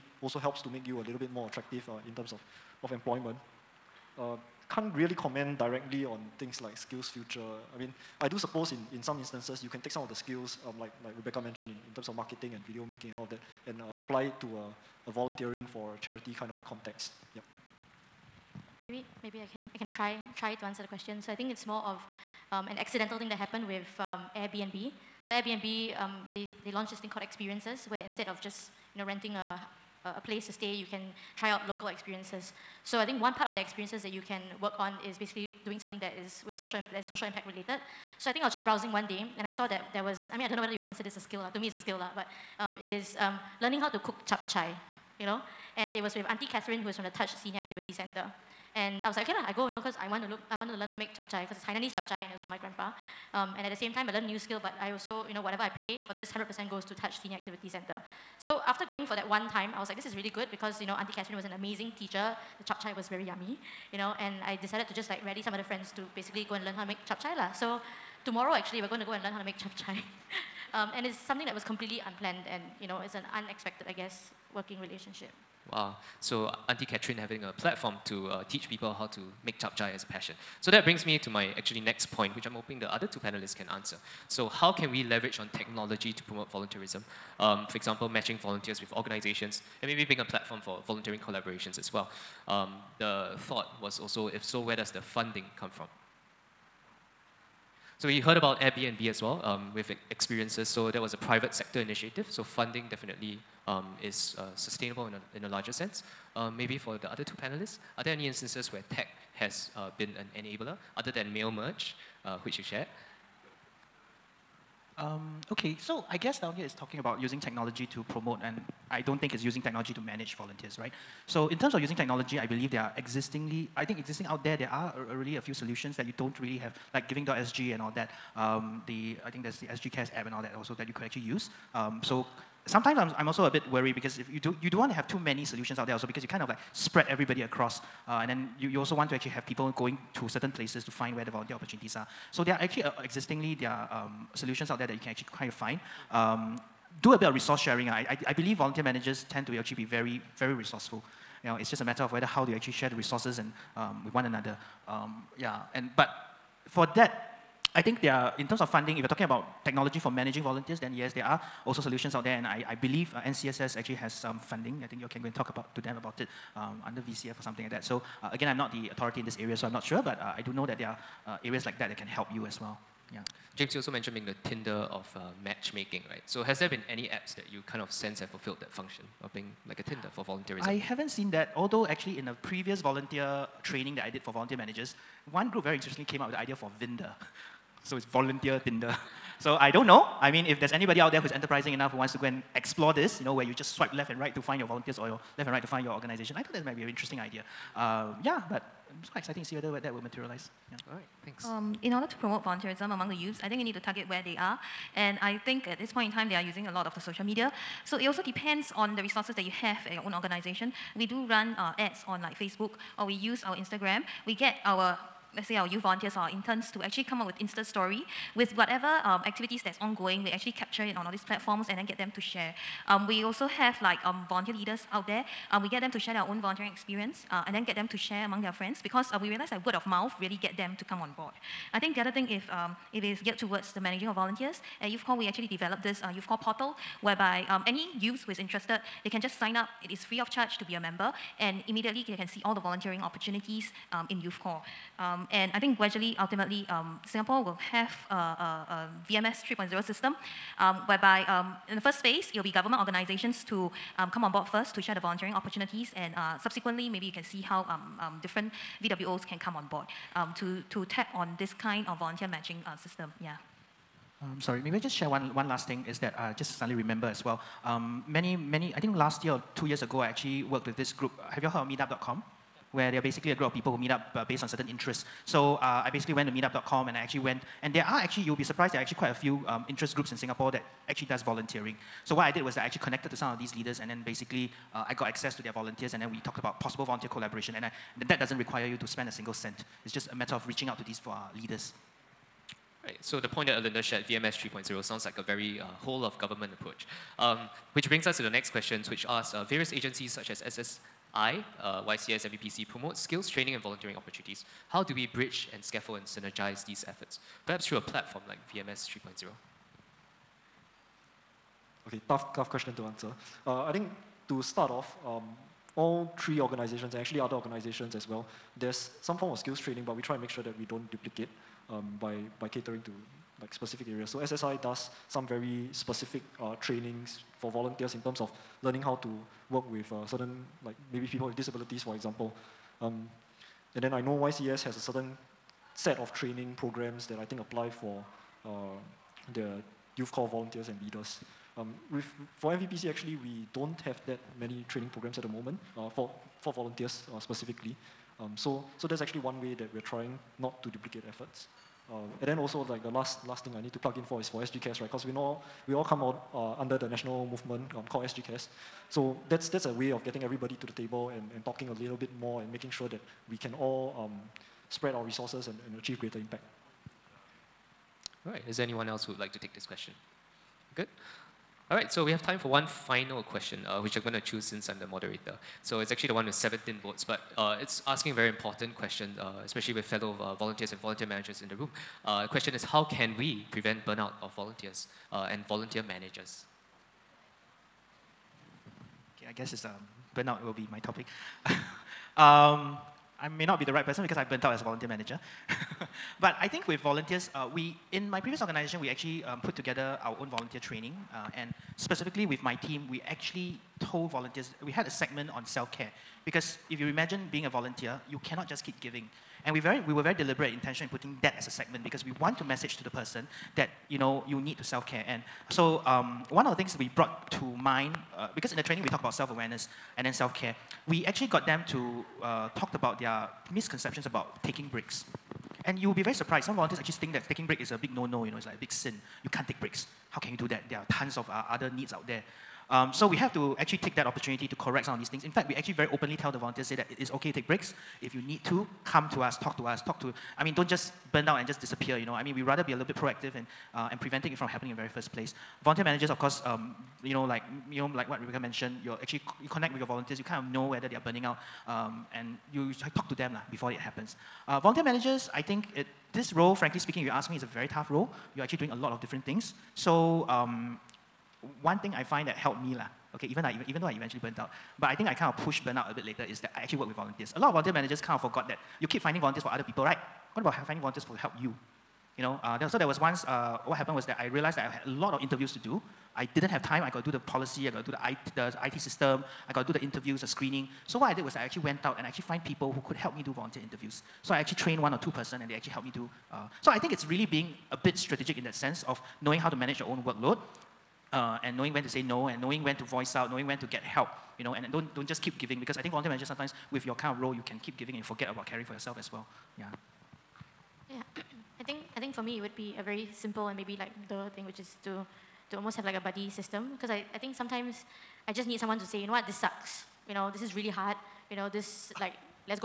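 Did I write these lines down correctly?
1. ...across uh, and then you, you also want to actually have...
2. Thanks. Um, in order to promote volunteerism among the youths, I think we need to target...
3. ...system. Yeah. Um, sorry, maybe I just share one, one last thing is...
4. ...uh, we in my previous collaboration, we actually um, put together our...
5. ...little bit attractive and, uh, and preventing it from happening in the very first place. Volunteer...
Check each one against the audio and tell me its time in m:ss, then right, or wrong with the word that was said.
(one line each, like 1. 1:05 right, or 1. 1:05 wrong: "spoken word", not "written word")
1. 2:17 right
2. 3:21 right
3. 4:22 right
4. 6:37 wrong: "organization", not "collaboration"
5. 7:22 wrong: "proactive", not "attractive".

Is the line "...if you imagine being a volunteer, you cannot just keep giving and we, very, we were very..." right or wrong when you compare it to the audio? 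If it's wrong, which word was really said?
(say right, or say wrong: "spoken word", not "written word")
right.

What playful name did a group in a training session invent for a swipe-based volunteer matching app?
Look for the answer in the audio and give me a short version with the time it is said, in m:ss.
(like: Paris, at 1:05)
Vinder, at 3:06.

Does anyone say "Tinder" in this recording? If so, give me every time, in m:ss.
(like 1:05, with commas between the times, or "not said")
2:54, 2:59, 3:08.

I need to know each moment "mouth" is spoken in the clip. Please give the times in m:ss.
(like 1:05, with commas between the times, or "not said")
3:49.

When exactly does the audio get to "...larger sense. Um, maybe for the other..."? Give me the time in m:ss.
1:45.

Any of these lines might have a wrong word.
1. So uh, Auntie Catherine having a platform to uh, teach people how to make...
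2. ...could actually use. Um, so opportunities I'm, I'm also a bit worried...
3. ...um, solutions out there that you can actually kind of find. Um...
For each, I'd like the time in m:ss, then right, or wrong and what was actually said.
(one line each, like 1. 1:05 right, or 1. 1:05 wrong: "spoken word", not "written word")
1. 1:16 right
2. 2:10 wrong: "sometimes", not "opportunities"
3. 2:23 right.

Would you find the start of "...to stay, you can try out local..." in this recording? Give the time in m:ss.
0:30.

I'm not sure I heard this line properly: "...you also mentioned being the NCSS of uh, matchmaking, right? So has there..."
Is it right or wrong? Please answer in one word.
wrong.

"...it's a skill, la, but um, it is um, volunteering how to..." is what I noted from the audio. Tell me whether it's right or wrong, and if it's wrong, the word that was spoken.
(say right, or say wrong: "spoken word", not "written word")
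wrong: "learning", not "volunteering".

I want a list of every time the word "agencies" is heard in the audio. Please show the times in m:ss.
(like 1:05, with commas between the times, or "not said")
4:59.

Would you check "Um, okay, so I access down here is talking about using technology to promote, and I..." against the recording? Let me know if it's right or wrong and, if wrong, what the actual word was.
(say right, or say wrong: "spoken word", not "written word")
wrong: "guess", not "access".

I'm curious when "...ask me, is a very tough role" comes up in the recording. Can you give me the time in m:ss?
7:37.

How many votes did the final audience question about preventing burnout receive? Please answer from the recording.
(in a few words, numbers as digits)
17.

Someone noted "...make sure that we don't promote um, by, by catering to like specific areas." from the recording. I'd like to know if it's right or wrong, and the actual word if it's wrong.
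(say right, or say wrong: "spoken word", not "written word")
wrong: "duplicate", not "promote".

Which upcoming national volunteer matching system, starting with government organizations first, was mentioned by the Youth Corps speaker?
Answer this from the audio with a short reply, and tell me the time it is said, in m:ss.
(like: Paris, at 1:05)
VMS 3.0, at 4:09.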